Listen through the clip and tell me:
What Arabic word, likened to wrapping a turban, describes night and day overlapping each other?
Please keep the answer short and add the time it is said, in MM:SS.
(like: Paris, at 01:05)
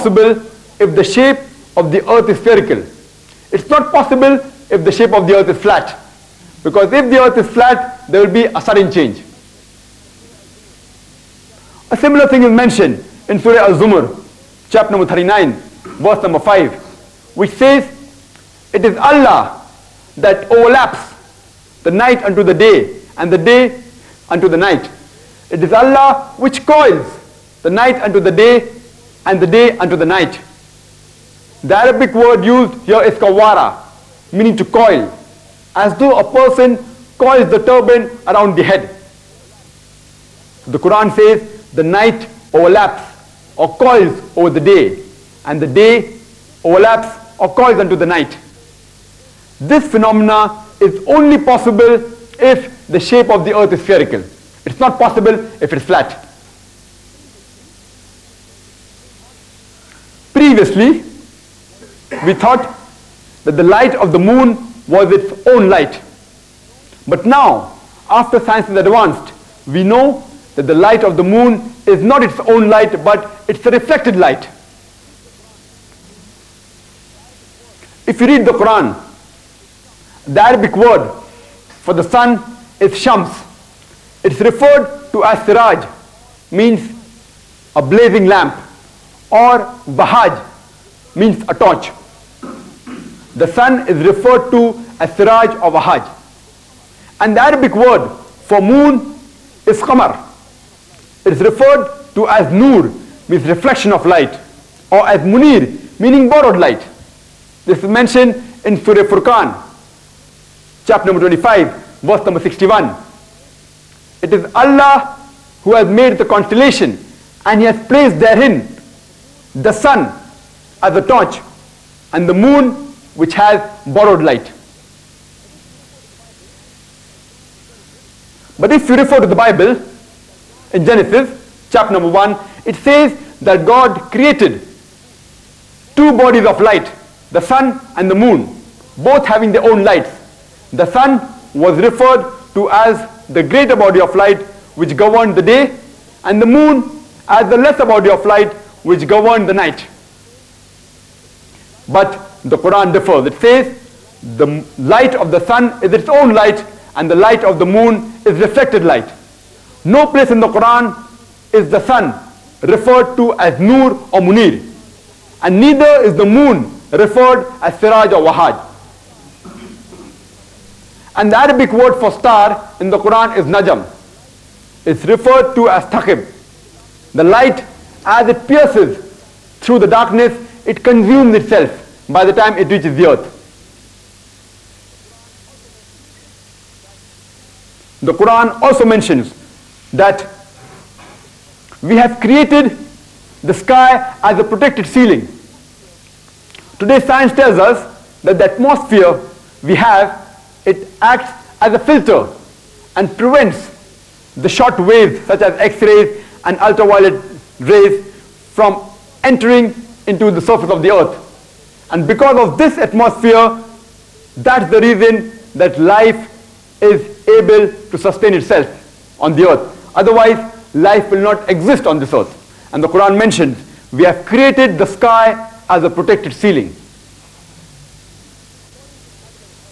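kawara, at 00:33.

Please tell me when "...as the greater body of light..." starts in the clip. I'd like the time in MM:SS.
02:22.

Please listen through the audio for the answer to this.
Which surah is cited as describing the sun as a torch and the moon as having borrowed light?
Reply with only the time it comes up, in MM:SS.
01:48.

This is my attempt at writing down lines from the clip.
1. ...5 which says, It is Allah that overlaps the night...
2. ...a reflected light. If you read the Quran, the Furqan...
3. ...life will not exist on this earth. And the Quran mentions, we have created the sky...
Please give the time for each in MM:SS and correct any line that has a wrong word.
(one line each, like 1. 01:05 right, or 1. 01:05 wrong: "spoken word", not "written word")
1. 00:16 right
2. 01:13 wrong: "Arabic", not "Furqan"
3. 03:40 right.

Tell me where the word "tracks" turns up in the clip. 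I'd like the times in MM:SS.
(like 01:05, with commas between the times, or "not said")
not said.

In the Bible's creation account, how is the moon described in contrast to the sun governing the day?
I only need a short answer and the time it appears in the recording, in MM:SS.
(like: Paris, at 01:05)
the lesser body of light, at 02:27.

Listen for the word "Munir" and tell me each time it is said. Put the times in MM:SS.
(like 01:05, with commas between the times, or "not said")
01:45, 02:44.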